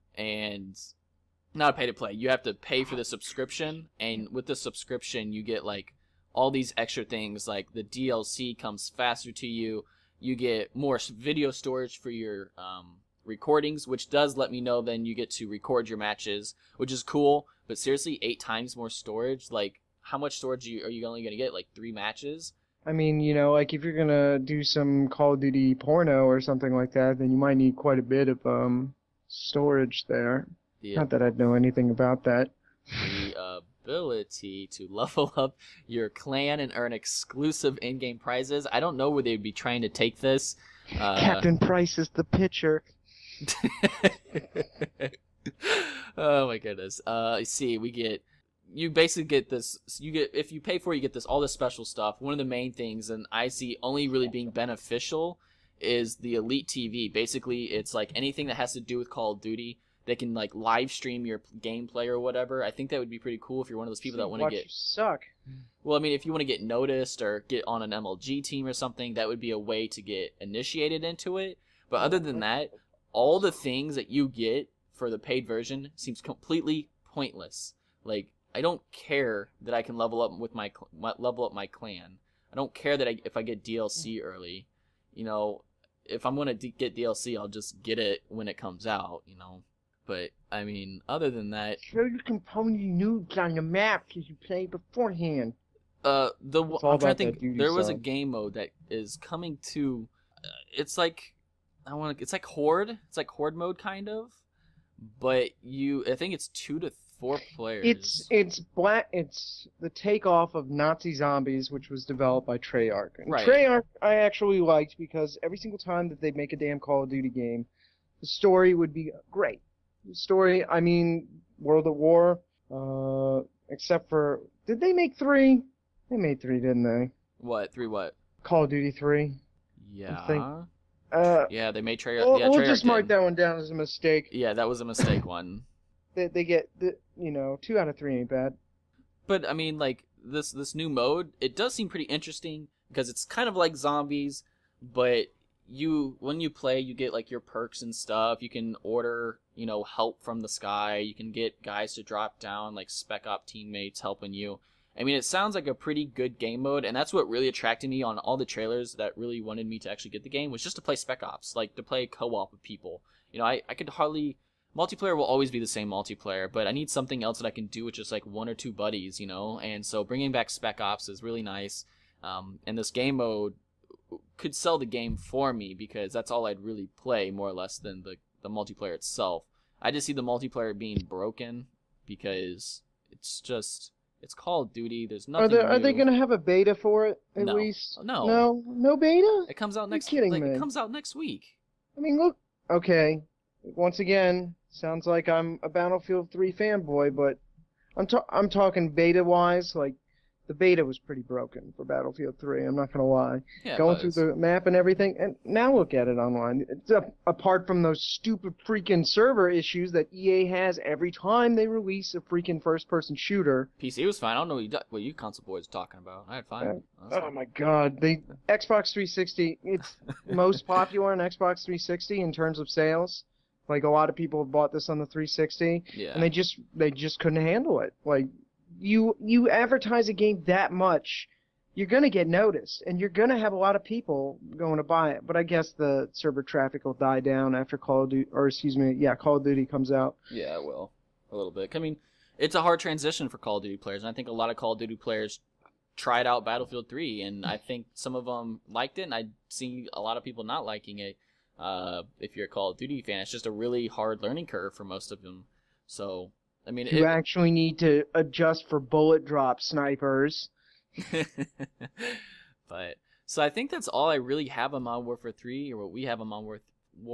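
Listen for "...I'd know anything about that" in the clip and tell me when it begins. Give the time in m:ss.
0:31.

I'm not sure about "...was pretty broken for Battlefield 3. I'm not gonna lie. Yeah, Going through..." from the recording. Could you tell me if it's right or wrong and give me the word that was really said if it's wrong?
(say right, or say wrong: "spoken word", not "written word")
right.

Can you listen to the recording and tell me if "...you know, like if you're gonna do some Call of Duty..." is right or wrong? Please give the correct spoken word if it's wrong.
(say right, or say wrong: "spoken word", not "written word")
right.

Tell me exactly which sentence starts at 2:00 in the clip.
The story, I mean, World at War.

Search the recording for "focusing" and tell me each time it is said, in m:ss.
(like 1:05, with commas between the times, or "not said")
not said.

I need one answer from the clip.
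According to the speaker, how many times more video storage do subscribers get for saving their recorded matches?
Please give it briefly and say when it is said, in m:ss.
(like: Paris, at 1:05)
8 times, at 0:18.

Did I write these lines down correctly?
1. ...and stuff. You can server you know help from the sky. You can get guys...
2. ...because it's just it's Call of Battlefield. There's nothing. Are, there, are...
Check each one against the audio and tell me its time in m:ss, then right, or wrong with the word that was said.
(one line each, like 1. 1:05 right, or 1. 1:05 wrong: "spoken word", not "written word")
1. 2:27 wrong: "order", not "server"
2. 3:02 wrong: "Duty", not "Battlefield".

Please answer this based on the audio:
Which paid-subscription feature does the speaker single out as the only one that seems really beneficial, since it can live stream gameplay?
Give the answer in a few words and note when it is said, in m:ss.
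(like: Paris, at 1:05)
Elite TV, at 0:56.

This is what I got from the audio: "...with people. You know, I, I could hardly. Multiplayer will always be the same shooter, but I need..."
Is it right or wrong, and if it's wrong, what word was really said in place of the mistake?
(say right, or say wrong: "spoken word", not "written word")
wrong: "multiplayer", not "shooter".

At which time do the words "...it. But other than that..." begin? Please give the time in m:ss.
1:11.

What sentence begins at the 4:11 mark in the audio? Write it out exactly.
Uh, if you're a Call of Duty fan, it's just a really hard learning curve for most of them.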